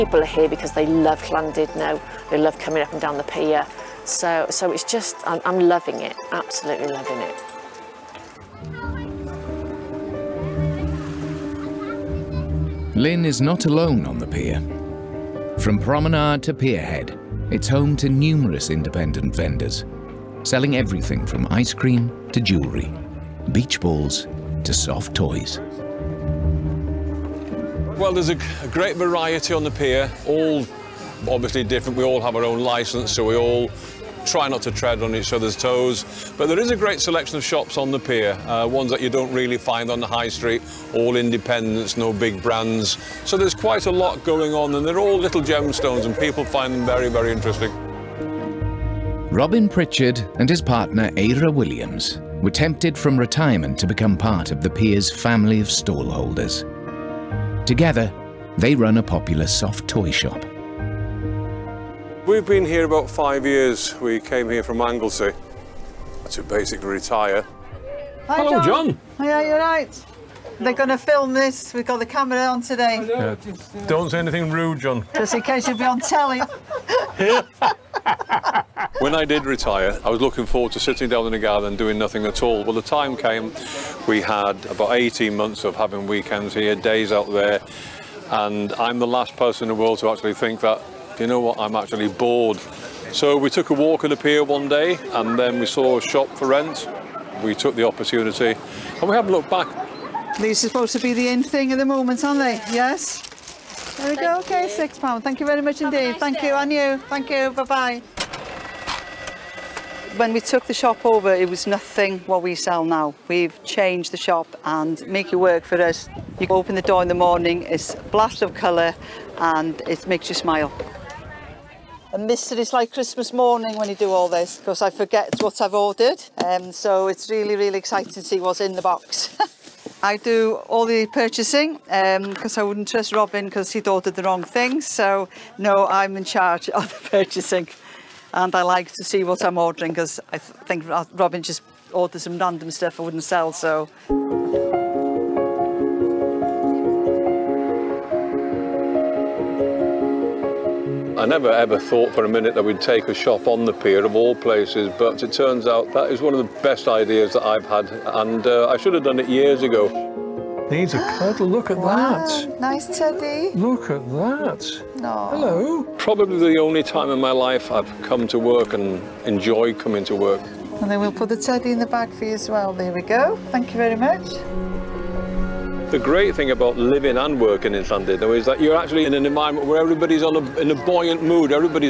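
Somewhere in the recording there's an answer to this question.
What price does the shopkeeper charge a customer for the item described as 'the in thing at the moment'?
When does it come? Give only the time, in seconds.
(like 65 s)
104 s.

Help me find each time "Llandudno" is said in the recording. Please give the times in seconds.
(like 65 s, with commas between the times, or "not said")
1 s, 177 s.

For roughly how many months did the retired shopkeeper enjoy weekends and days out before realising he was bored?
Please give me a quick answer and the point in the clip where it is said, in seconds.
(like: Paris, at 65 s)
18 months, at 84 s.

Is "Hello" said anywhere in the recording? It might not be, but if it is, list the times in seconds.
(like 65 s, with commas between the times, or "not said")
68 s, 165 s.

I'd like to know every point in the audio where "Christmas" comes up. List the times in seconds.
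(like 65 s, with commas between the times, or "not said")
122 s.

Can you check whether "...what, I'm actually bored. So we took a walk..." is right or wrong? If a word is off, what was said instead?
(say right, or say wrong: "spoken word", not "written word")
right.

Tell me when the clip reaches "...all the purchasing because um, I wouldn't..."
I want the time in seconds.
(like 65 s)
130 s.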